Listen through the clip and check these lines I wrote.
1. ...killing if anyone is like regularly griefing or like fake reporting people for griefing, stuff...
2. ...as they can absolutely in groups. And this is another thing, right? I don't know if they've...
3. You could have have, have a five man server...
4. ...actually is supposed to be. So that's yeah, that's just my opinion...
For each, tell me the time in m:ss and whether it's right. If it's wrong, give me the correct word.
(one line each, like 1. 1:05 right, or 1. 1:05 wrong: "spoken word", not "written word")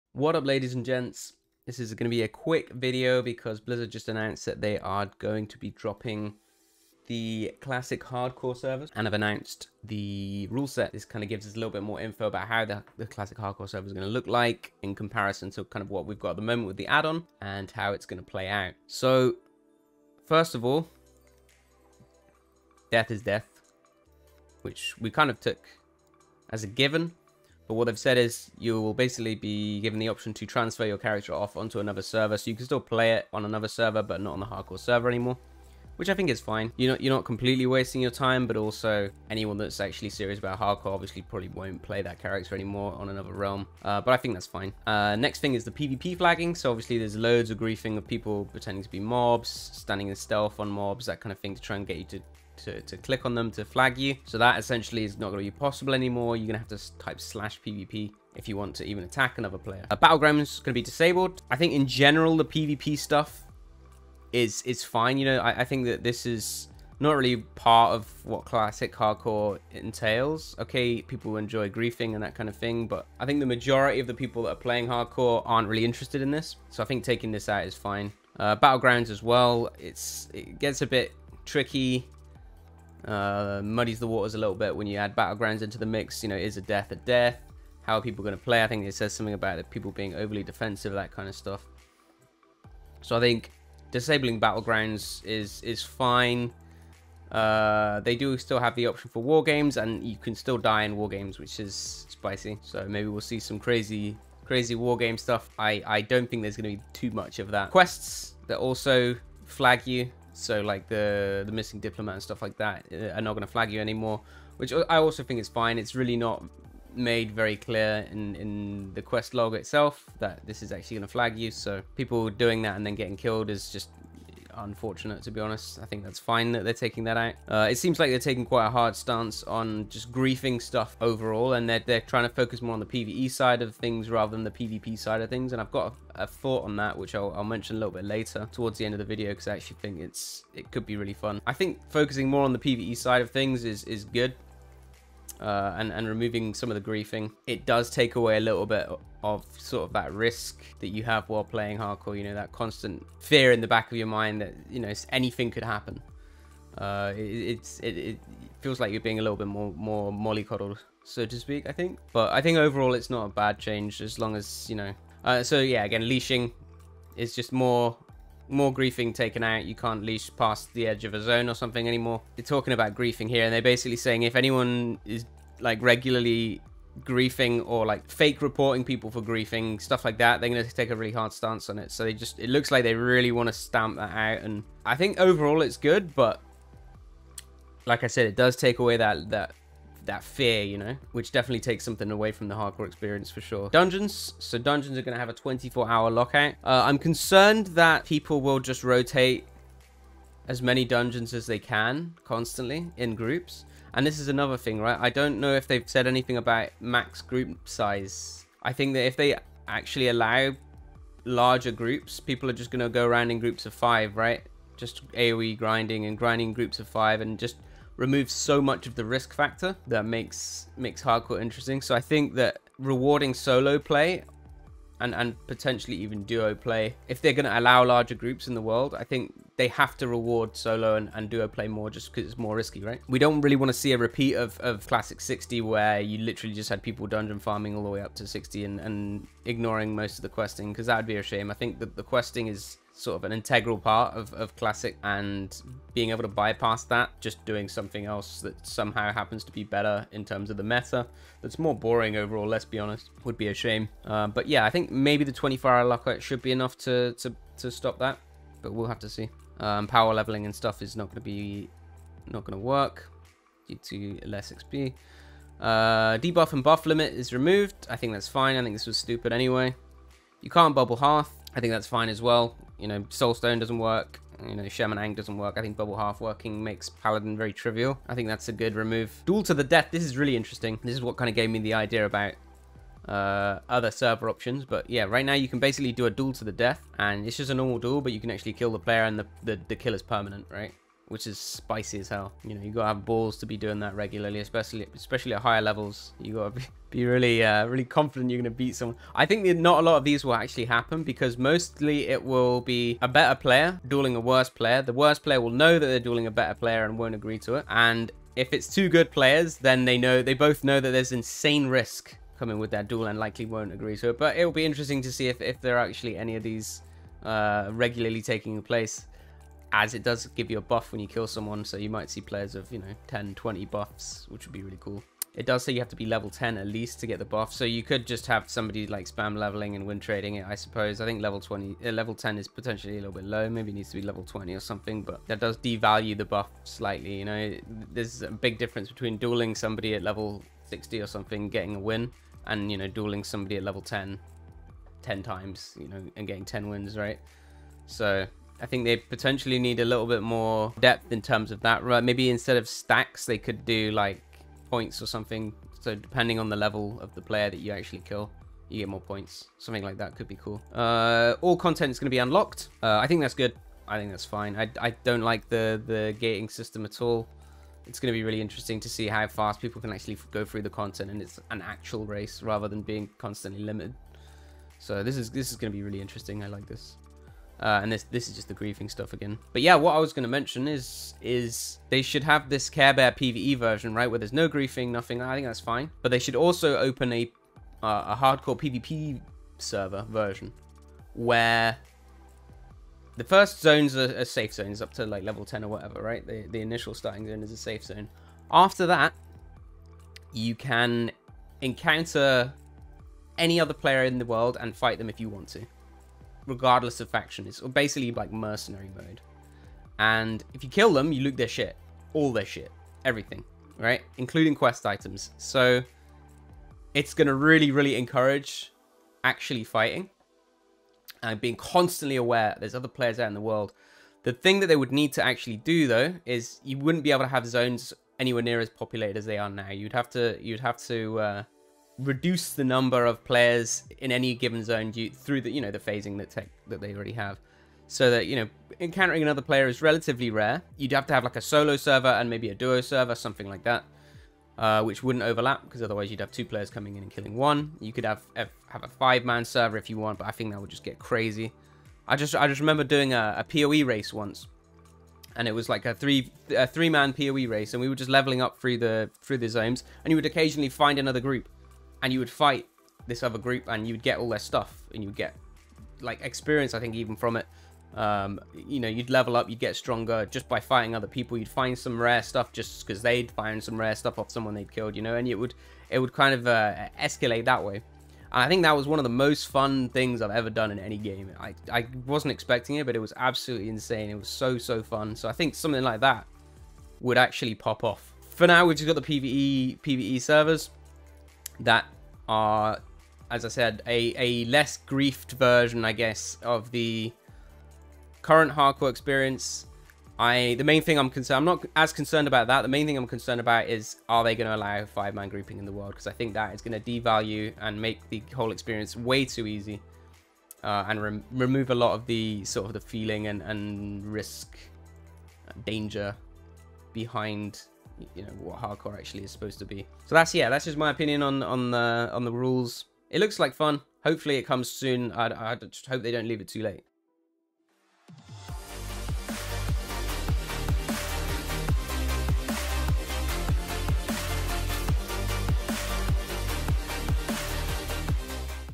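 1. 2:53 wrong: "saying", not "killing"
2. 3:21 wrong: "constantly", not "absolutely"
3. 7:27 right
4. 8:38 right.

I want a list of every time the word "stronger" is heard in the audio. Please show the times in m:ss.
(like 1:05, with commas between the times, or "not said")
7:49.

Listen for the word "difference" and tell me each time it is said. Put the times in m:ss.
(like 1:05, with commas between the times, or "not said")
5:38.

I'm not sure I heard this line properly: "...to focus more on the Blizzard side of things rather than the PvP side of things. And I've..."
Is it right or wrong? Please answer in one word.
wrong.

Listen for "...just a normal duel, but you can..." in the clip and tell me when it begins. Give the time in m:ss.
4:47.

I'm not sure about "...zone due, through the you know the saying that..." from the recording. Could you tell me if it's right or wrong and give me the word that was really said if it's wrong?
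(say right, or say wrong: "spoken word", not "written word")
wrong: "phasing", not "saying".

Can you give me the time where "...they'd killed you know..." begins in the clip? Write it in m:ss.
7:54.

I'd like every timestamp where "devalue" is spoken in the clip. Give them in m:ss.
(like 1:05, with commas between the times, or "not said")
5:35, 8:26.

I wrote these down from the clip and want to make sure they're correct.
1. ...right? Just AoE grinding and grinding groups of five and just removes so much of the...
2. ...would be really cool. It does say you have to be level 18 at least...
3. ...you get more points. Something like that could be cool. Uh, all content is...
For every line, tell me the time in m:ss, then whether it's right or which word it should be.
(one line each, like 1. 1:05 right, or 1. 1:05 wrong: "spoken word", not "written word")
1. 3:34 right
2. 5:24 wrong: "10", not "18"
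3. 5:58 right.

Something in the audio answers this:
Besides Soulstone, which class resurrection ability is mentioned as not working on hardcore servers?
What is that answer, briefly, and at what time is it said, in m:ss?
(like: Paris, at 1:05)
Shaman Ankh, at 4:34.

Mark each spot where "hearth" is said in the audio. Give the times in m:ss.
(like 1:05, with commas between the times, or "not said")
4:30, 4:35.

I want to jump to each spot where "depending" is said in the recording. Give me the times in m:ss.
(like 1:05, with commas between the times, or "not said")
5:55.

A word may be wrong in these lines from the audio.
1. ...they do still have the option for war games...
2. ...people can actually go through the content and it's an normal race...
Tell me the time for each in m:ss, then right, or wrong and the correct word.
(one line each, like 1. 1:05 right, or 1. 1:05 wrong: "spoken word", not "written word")
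1. 1:38 right
2. 6:09 wrong: "actual", not "normal".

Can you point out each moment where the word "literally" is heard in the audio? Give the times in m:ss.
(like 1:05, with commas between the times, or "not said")
3:56.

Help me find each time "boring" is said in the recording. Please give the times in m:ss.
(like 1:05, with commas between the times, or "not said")
4:11.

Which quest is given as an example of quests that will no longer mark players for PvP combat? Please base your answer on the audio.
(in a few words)
The Missing Diplomat.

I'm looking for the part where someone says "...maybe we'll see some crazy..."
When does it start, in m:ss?
1:42.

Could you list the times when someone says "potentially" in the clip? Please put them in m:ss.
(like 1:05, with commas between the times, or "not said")
3:45, 5:32, 5:48.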